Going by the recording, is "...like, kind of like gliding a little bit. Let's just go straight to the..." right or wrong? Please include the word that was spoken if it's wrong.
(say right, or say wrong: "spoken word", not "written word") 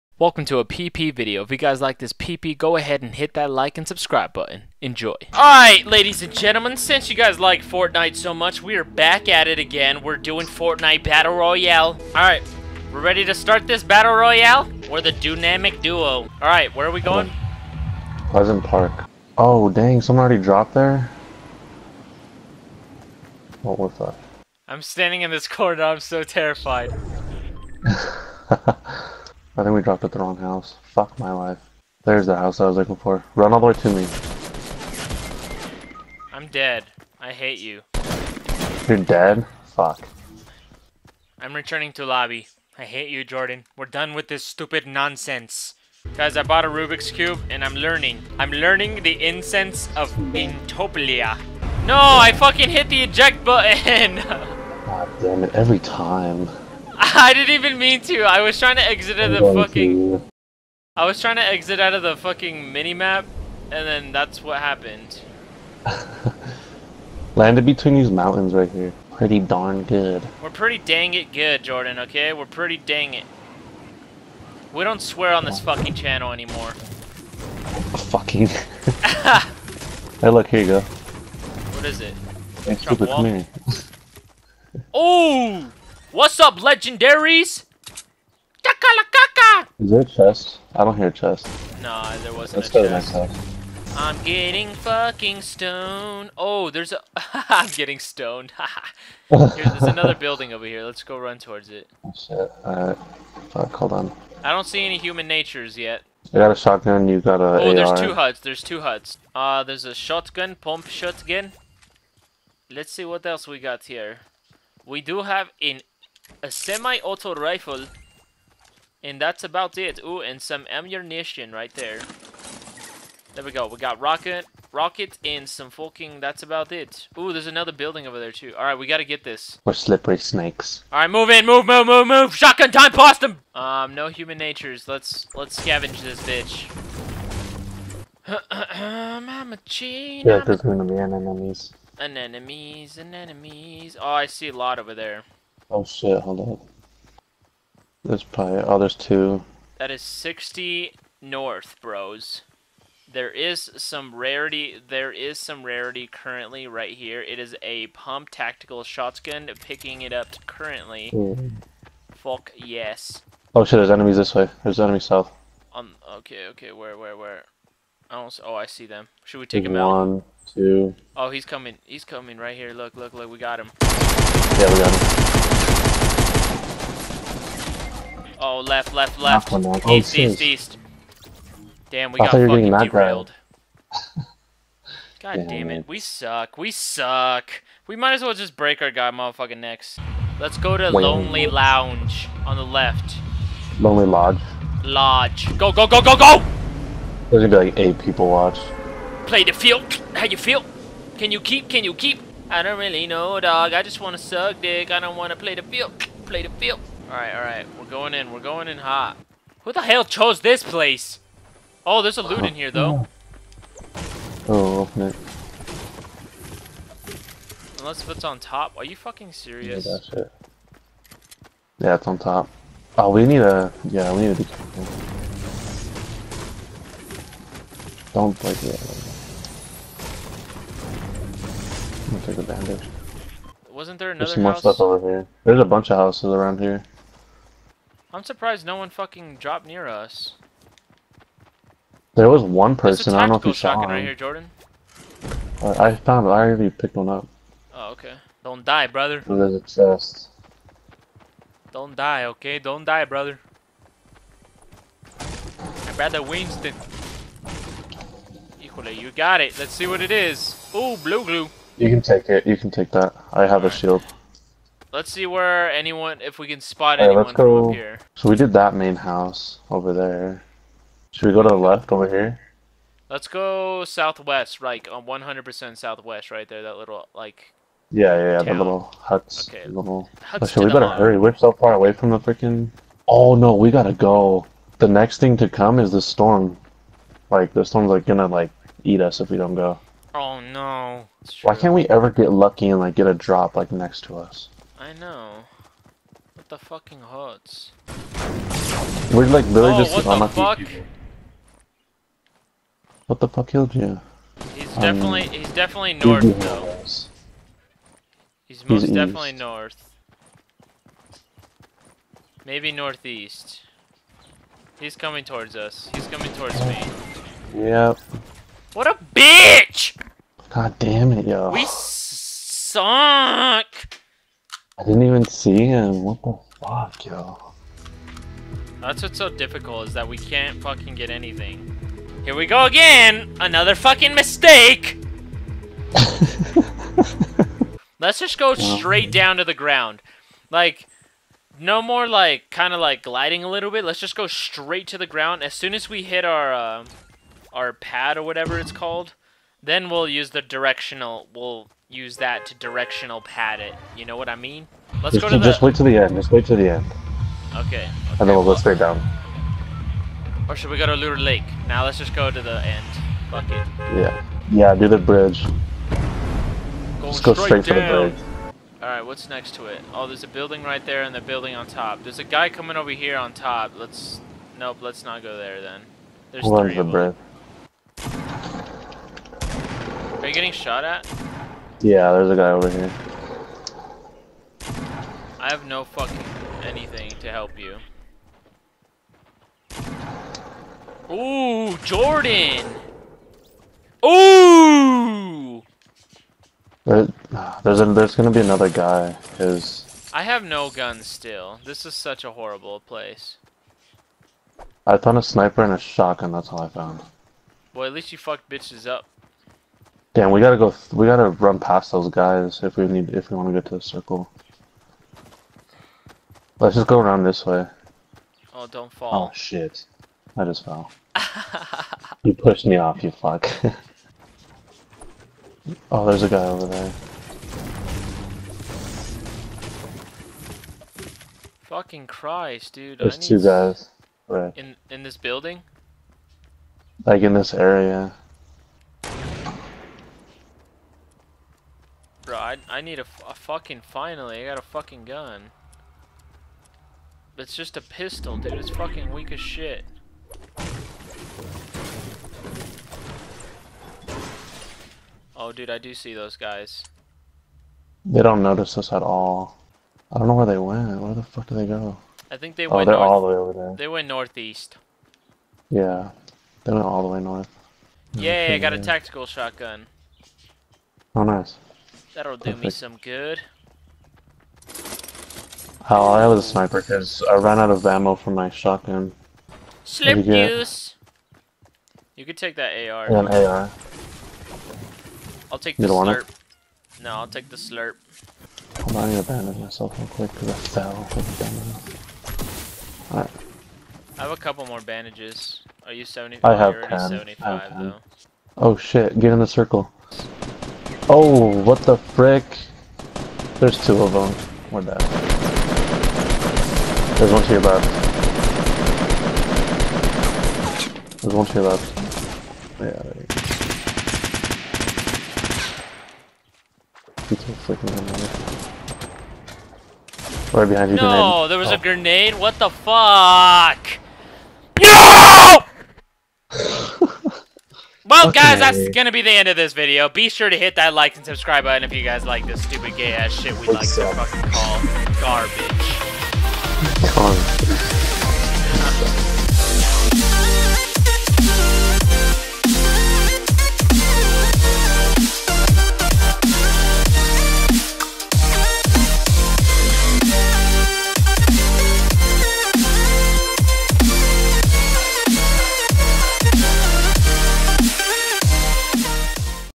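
right.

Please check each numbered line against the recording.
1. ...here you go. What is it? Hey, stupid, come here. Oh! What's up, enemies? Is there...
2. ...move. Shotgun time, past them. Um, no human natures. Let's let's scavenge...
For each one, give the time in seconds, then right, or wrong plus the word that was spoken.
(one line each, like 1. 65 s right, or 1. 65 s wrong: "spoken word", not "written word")
1. 80 s wrong: "legendaries", not "enemies"
2. 132 s right.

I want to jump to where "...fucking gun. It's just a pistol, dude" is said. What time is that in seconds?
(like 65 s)
444 s.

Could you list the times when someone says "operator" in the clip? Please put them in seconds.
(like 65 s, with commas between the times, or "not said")
not said.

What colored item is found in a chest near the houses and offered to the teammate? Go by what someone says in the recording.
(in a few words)
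blue glue.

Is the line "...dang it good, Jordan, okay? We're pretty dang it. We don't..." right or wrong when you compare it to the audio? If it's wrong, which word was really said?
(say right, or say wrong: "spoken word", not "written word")
right.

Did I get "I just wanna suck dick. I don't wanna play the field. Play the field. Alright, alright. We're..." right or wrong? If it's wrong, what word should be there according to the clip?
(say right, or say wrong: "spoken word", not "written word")
right.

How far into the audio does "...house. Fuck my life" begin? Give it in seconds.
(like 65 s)
30 s.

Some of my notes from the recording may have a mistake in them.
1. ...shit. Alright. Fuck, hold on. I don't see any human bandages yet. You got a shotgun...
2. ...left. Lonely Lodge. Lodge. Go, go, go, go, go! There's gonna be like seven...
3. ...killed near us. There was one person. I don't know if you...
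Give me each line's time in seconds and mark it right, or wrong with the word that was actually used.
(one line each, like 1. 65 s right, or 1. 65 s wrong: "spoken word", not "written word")
1. 102 s wrong: "natures", not "bandages"
2. 192 s wrong: "eight", not "seven"
3. 239 s wrong: "dropped", not "killed".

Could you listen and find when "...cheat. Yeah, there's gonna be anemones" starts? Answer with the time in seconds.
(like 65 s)
139 s.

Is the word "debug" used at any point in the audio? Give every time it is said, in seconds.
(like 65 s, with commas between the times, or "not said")
not said.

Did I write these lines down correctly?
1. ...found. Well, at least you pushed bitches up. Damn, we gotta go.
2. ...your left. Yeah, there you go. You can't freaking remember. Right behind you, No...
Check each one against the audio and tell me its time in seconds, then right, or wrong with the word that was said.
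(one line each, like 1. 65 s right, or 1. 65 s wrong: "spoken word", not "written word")
1. 406 s wrong: "fucked", not "pushed"
2. 511 s right.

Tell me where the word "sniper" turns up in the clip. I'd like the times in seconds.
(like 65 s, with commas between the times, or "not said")
405 s, 476 s.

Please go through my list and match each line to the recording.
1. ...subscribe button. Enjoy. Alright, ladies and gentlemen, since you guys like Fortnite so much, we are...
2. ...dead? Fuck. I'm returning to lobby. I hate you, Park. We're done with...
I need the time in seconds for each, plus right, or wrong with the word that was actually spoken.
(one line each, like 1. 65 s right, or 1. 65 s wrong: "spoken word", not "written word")
1. 3 s right
2. 39 s wrong: "Jordan", not "Park".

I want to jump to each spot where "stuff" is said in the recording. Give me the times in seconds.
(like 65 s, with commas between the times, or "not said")
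234 s.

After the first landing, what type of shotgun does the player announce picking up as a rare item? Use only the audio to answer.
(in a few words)
pump tactical shotgun.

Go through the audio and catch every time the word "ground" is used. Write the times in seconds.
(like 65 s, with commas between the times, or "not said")
339 s, 345 s.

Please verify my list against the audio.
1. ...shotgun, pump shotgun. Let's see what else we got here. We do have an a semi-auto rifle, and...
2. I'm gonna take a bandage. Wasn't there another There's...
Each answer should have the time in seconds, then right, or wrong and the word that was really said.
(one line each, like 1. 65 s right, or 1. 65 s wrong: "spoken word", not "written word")
1. 109 s right
2. 232 s right.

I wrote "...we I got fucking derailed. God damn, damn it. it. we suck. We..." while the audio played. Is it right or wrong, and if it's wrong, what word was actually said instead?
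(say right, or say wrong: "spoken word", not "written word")
right.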